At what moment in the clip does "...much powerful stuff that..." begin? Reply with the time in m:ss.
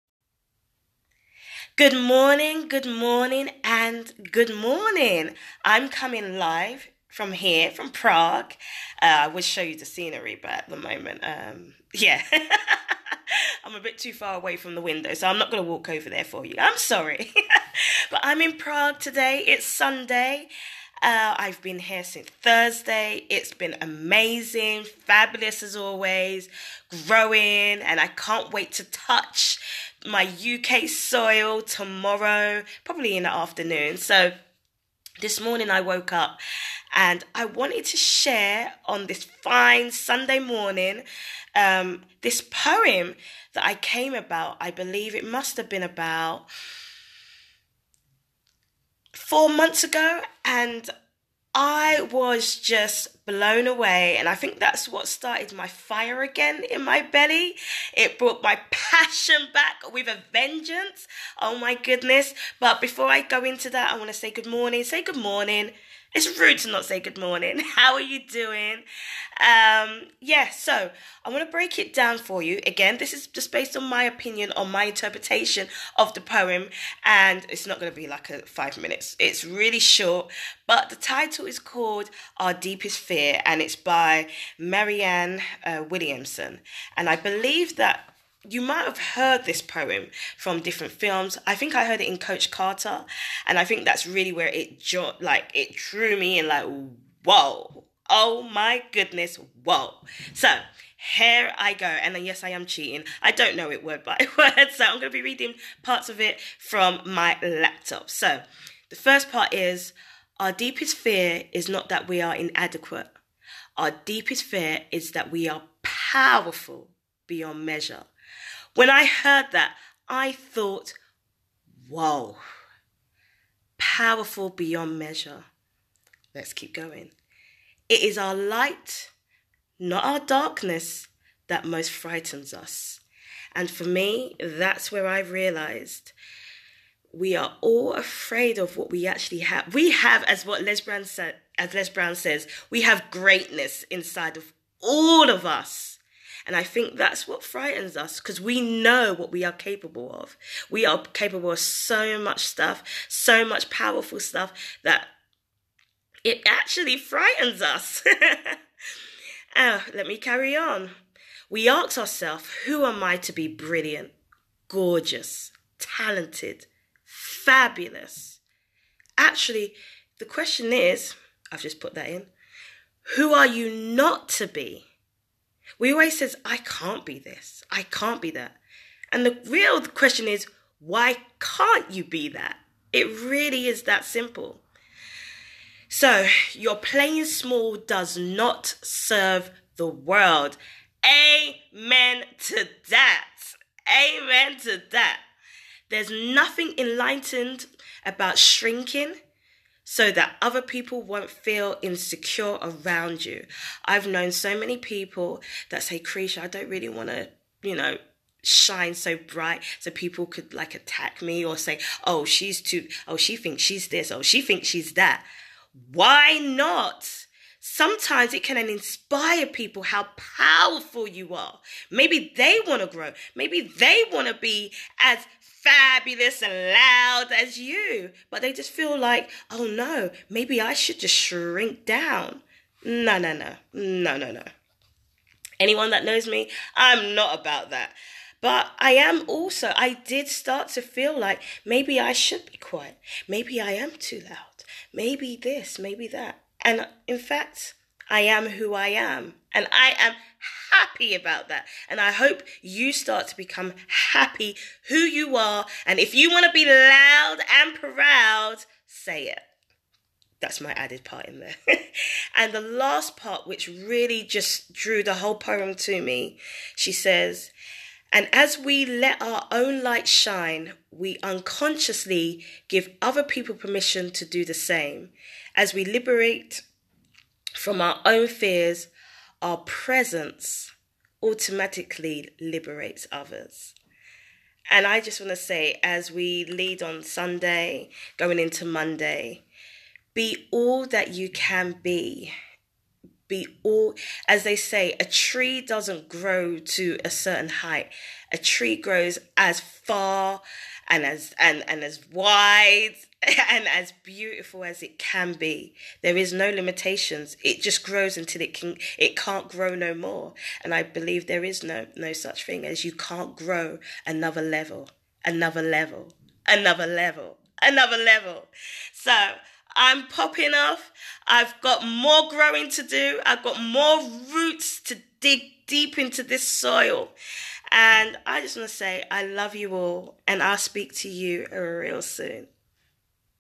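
2:33.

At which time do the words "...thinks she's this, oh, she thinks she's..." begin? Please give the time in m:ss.
3:33.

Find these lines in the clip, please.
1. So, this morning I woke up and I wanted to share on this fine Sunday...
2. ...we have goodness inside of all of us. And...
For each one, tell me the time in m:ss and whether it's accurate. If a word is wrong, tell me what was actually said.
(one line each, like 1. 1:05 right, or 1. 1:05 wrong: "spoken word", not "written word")
1. 0:33 right
2. 2:22 wrong: "greatness", not "goodness".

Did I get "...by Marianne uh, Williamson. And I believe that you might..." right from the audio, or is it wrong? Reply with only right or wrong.
right.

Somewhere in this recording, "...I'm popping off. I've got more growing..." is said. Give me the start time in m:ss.
5:19.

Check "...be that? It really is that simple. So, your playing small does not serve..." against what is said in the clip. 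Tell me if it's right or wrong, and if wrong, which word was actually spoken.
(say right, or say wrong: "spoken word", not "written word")
right.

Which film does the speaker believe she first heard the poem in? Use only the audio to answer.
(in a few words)
Coach Carter.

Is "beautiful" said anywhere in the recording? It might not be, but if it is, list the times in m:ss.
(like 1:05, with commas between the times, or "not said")
5:04.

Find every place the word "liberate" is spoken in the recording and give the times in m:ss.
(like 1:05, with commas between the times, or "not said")
4:35, 4:42.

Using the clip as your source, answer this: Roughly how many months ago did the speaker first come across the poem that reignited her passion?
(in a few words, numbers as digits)
4 months.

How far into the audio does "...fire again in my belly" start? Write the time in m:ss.
0:55.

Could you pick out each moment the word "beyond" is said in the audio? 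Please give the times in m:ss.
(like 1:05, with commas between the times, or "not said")
1:57, 2:04.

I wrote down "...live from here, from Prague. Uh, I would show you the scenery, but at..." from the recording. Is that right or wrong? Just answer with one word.
right.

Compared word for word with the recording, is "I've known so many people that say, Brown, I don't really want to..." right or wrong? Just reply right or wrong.
wrong.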